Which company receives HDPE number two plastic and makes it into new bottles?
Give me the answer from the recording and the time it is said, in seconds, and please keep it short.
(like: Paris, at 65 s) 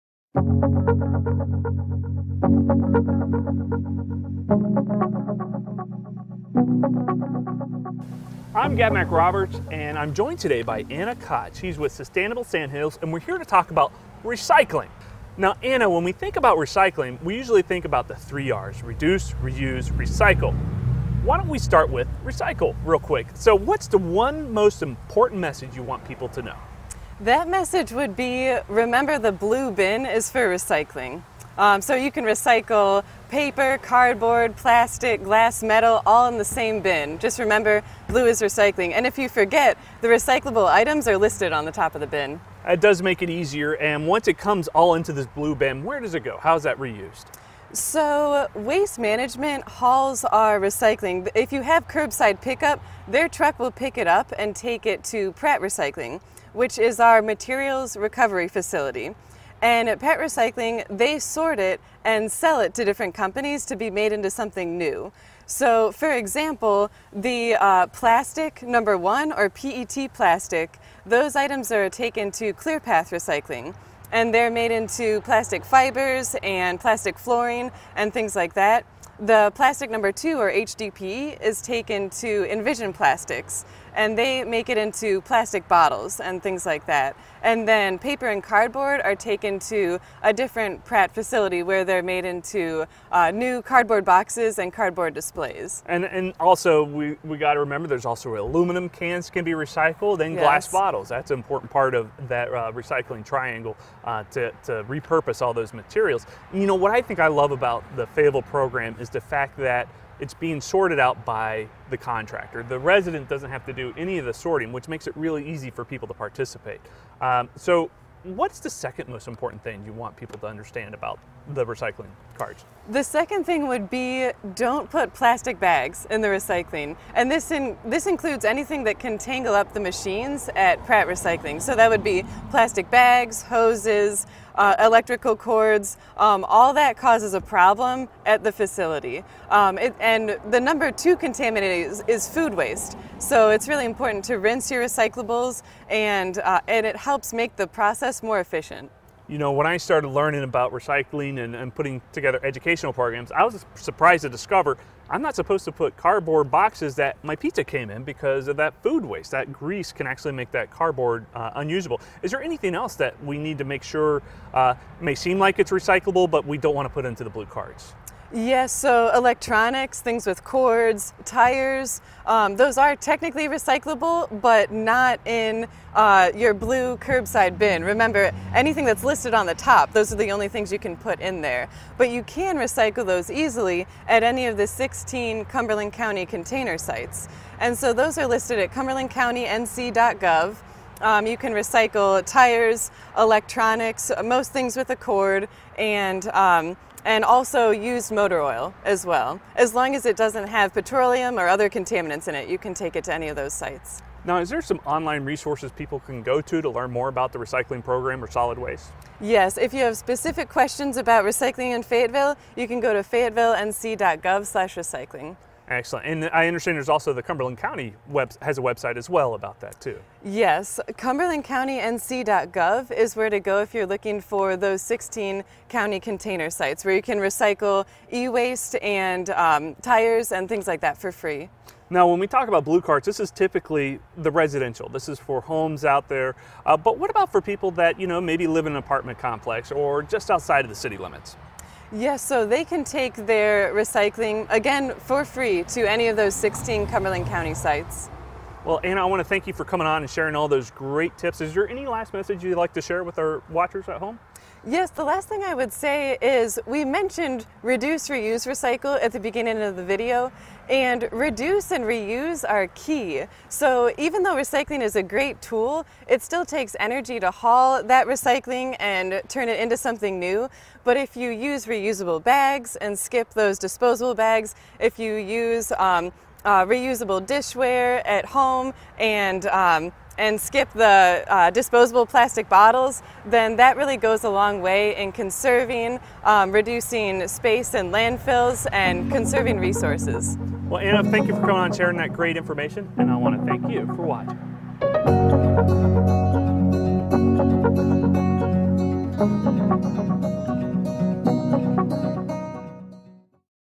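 Envision Plastics, at 82 s.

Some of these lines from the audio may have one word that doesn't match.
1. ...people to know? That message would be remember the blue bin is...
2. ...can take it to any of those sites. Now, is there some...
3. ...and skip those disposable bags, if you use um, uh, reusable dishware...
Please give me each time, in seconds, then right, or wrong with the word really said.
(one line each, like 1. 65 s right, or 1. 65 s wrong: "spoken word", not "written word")
1. 26 s right
2. 202 s right
3. 272 s right.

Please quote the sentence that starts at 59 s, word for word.
And at Pratt Recycling, they sort it and sell it to different companies to be made into something new.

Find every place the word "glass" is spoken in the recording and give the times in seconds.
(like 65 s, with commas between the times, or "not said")
35 s, 100 s.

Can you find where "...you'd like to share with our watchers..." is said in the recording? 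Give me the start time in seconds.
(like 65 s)
252 s.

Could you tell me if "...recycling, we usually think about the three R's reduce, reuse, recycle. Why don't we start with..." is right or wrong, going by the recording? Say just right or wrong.
right.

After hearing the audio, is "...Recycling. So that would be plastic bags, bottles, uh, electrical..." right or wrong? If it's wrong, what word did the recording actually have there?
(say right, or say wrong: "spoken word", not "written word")
wrong: "hoses", not "bottles".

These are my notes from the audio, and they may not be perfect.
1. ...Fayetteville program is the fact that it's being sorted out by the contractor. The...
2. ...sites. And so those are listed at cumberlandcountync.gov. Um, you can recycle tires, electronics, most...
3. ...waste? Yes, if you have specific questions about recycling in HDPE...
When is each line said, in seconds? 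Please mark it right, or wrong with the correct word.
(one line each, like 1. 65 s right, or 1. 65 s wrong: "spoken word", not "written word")
1. 108 s right
2. 186 s right
3. 208 s wrong: "Fayetteville", not "HDPE".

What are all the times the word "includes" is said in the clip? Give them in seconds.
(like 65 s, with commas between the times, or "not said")
128 s.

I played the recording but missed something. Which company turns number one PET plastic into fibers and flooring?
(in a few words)
ClearPath Recycling.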